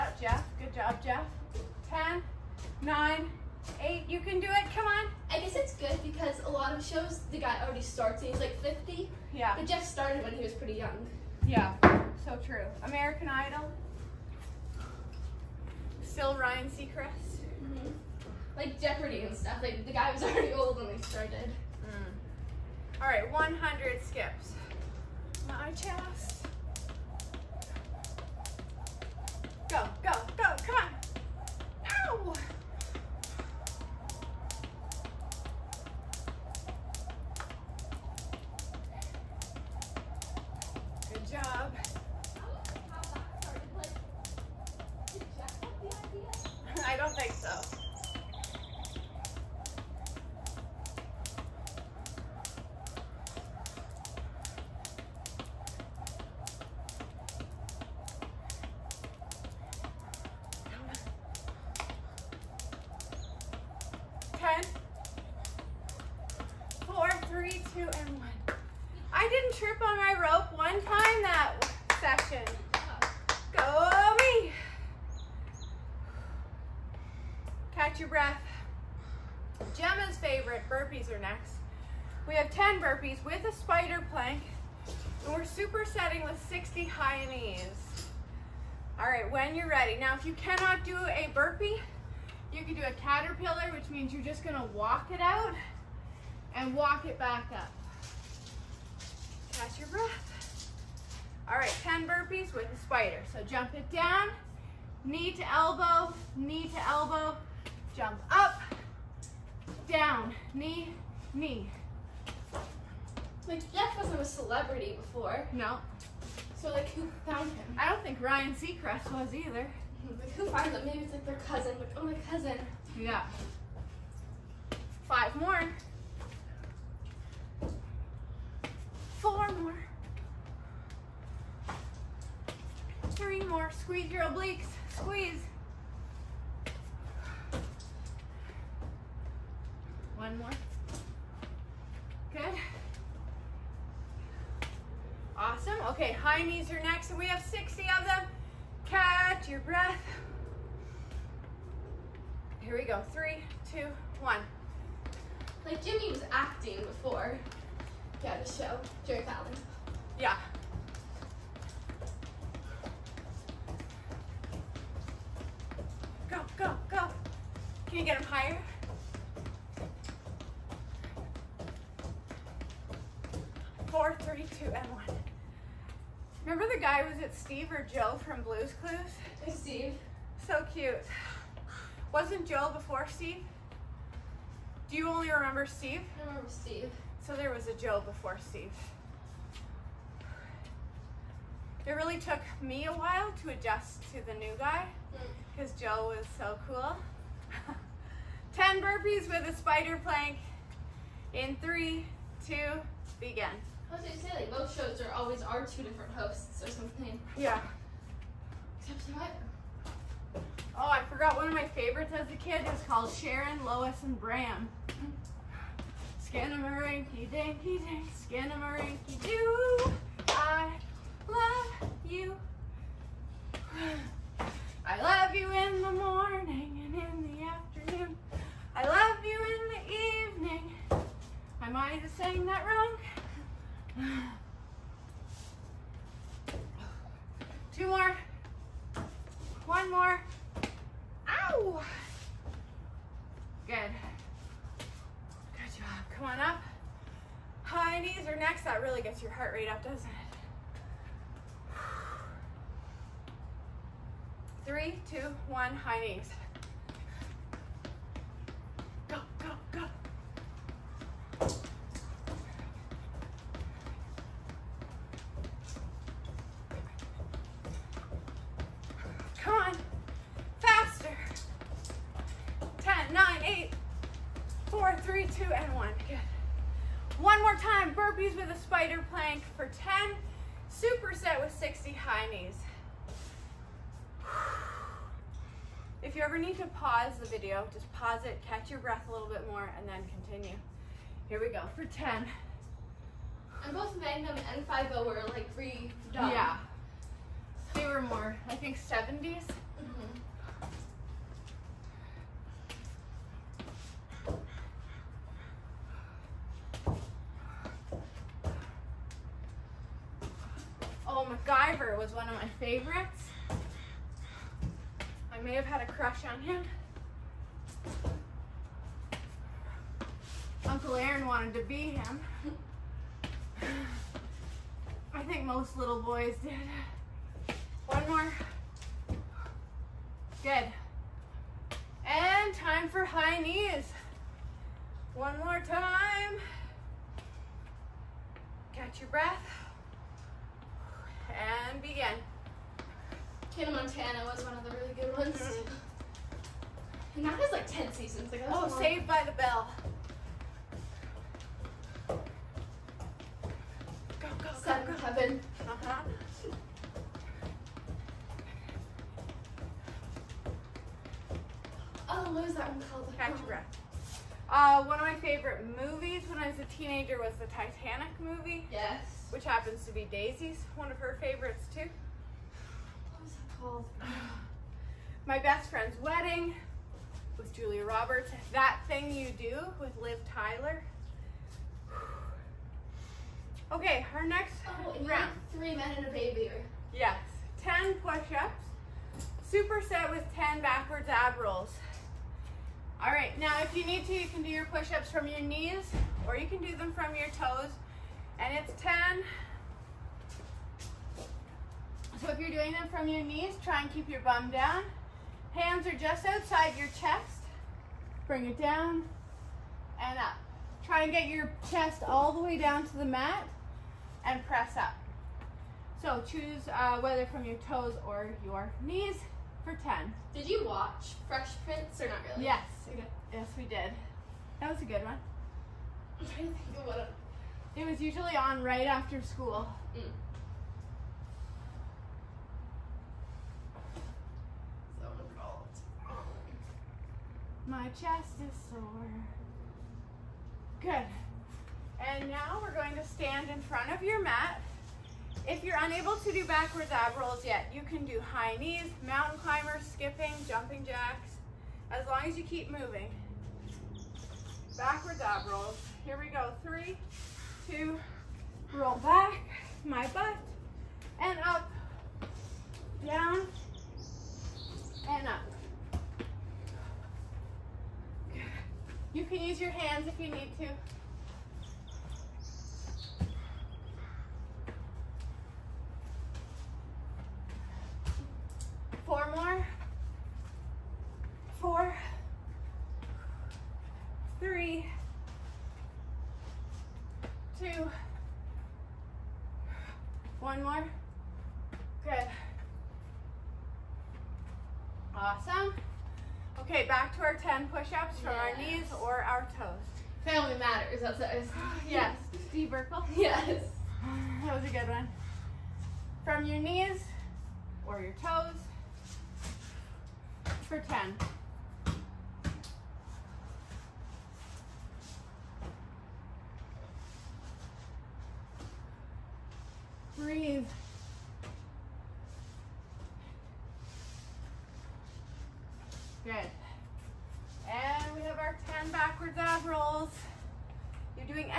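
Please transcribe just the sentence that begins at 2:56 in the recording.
Remember the guy, was it Steve or Joe from Blue's Clues?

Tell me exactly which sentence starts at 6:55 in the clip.
So choose uh, whether from your toes or your knees for 10.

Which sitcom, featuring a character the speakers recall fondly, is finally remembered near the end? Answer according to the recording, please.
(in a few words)
Family Matters.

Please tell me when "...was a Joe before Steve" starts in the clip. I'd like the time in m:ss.
3:07.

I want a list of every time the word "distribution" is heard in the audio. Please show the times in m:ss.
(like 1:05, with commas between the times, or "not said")
not said.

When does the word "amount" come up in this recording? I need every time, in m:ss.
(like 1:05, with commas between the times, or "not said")
not said.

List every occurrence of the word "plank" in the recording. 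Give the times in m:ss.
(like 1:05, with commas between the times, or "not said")
1:24, 3:20, 4:39.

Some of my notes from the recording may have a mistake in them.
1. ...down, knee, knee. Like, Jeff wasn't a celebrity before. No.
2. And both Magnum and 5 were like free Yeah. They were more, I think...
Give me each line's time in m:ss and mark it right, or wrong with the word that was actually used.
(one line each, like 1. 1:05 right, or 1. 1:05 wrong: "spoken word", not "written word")
1. 1:49 right
2. 4:53 right.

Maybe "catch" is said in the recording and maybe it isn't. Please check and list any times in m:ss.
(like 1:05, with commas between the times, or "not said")
1:39, 2:28, 4:48, 5:38.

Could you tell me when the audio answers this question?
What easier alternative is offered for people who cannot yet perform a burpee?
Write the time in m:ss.
1:32.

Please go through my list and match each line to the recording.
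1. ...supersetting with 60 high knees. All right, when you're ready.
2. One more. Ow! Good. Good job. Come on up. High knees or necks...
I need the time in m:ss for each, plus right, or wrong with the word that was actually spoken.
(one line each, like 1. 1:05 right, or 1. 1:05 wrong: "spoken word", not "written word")
1. 1:25 right
2. 3:59 right.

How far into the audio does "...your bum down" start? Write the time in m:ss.
6:44.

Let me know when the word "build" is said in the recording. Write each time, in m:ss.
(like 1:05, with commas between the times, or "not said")
not said.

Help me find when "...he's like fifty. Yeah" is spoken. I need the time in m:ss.
0:08.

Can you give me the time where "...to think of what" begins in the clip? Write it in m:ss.
7:06.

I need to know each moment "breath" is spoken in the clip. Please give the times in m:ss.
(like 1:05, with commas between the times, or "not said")
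1:39, 2:29, 4:48, 5:39, 6:03.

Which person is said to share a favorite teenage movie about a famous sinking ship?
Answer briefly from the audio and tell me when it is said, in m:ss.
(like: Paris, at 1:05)
Daisy, at 6:10.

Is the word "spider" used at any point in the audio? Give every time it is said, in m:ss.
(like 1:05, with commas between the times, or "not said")
1:23, 1:42, 3:19, 4:38.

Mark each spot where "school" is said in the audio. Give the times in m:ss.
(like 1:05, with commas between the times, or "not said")
7:09.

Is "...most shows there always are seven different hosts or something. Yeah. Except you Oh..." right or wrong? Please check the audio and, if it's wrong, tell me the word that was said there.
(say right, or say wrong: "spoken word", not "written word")
wrong: "two", not "seven".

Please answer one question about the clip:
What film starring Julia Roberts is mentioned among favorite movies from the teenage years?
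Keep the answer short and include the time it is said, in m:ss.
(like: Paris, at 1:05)
My Best Friend's Wedding, at 6:15.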